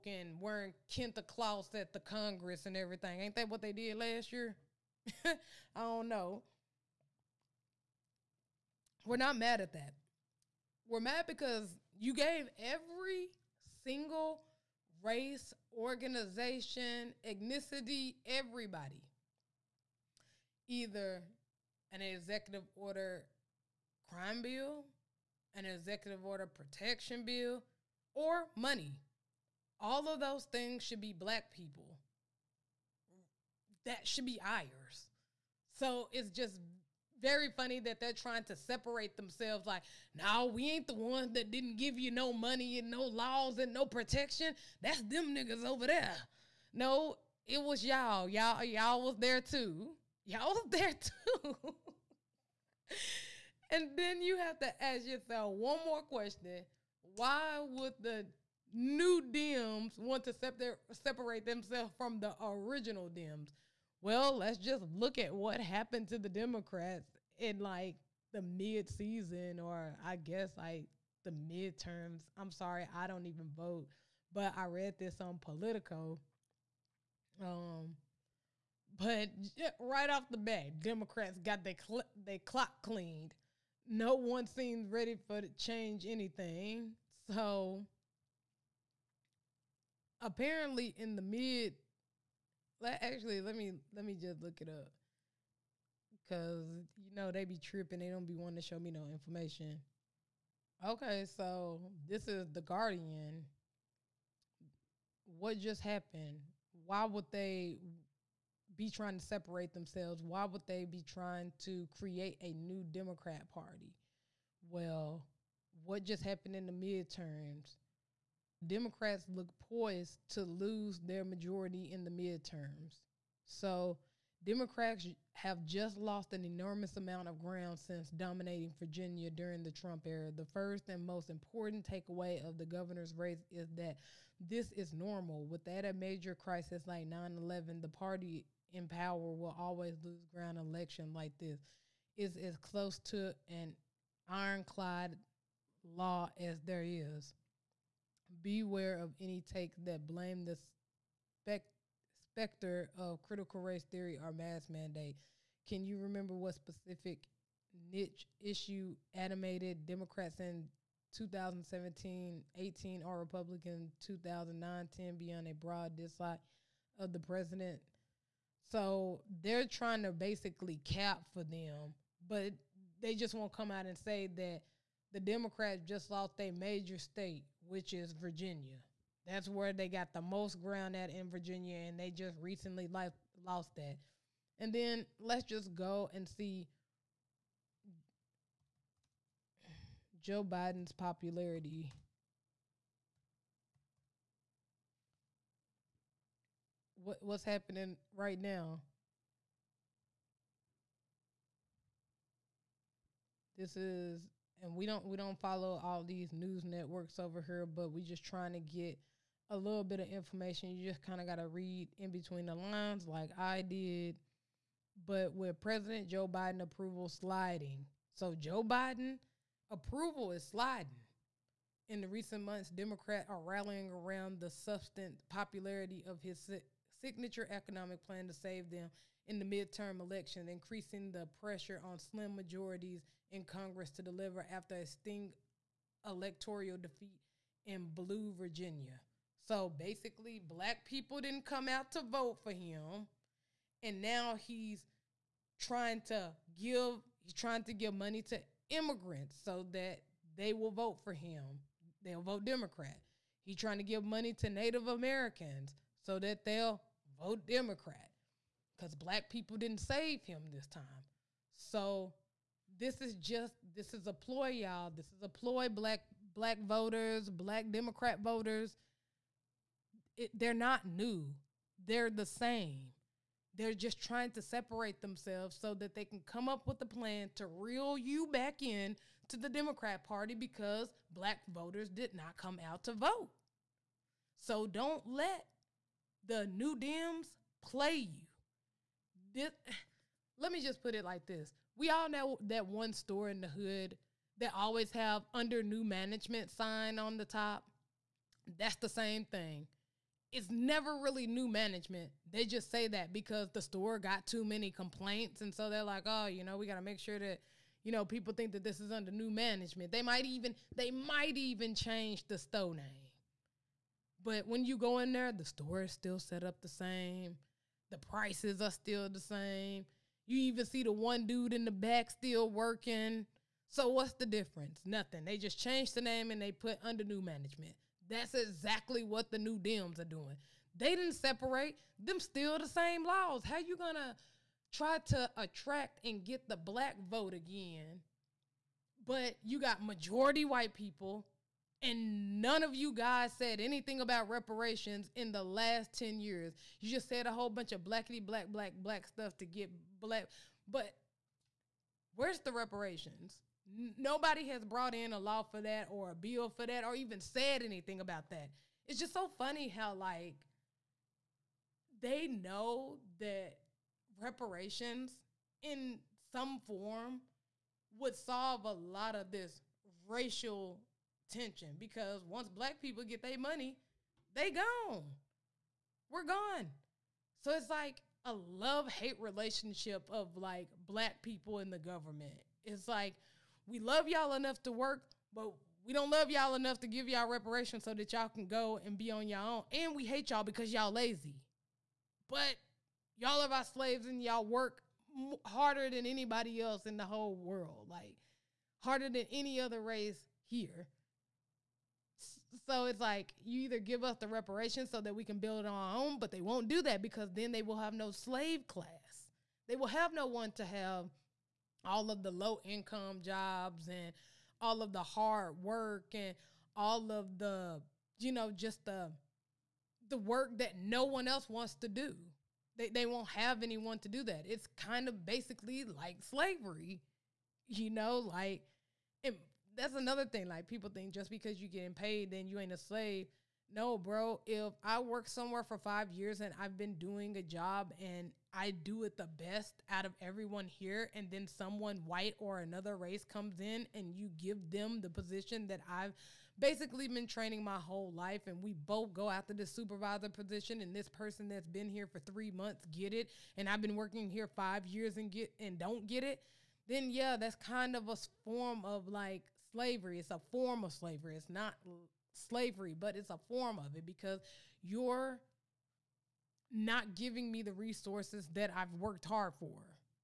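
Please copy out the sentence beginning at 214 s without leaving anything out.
But with President Joe Biden approval sliding, so Joe Biden approval is sliding.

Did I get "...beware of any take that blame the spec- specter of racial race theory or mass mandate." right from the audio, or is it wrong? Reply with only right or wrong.
wrong.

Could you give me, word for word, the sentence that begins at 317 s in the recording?
The prices are still the same.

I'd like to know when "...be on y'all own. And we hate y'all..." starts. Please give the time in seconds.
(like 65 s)
388 s.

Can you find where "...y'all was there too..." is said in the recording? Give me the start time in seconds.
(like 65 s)
48 s.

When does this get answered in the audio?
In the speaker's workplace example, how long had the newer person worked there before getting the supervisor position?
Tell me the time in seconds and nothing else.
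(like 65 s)
452 s.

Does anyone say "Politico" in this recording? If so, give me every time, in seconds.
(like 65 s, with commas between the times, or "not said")
75 s.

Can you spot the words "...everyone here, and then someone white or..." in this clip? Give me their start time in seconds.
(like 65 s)
440 s.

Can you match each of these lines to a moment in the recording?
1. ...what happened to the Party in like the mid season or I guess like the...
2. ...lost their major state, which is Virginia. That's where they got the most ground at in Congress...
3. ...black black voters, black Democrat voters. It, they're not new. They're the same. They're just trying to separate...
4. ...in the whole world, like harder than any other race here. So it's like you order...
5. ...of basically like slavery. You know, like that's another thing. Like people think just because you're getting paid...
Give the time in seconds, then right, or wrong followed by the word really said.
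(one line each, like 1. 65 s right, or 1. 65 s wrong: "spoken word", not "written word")
1. 65 s wrong: "Democrats", not "Party"
2. 176 s wrong: "Virginia", not "Congress"
3. 265 s right
4. 396 s wrong: "either", not "order"
5. 425 s right.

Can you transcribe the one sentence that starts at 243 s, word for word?
And now he's trying to give he's trying to give money to immigrants so that they will vote for him.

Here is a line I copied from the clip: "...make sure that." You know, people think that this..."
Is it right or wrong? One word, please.
right.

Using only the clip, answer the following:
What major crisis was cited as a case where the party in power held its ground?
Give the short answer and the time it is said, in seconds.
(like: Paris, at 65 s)
9/11, at 137 s.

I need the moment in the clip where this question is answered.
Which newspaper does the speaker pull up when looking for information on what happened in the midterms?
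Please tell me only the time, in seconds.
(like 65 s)
102 s.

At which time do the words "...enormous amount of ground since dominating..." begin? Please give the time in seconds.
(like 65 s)
126 s.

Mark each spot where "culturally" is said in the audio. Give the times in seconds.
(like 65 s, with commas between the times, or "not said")
not said.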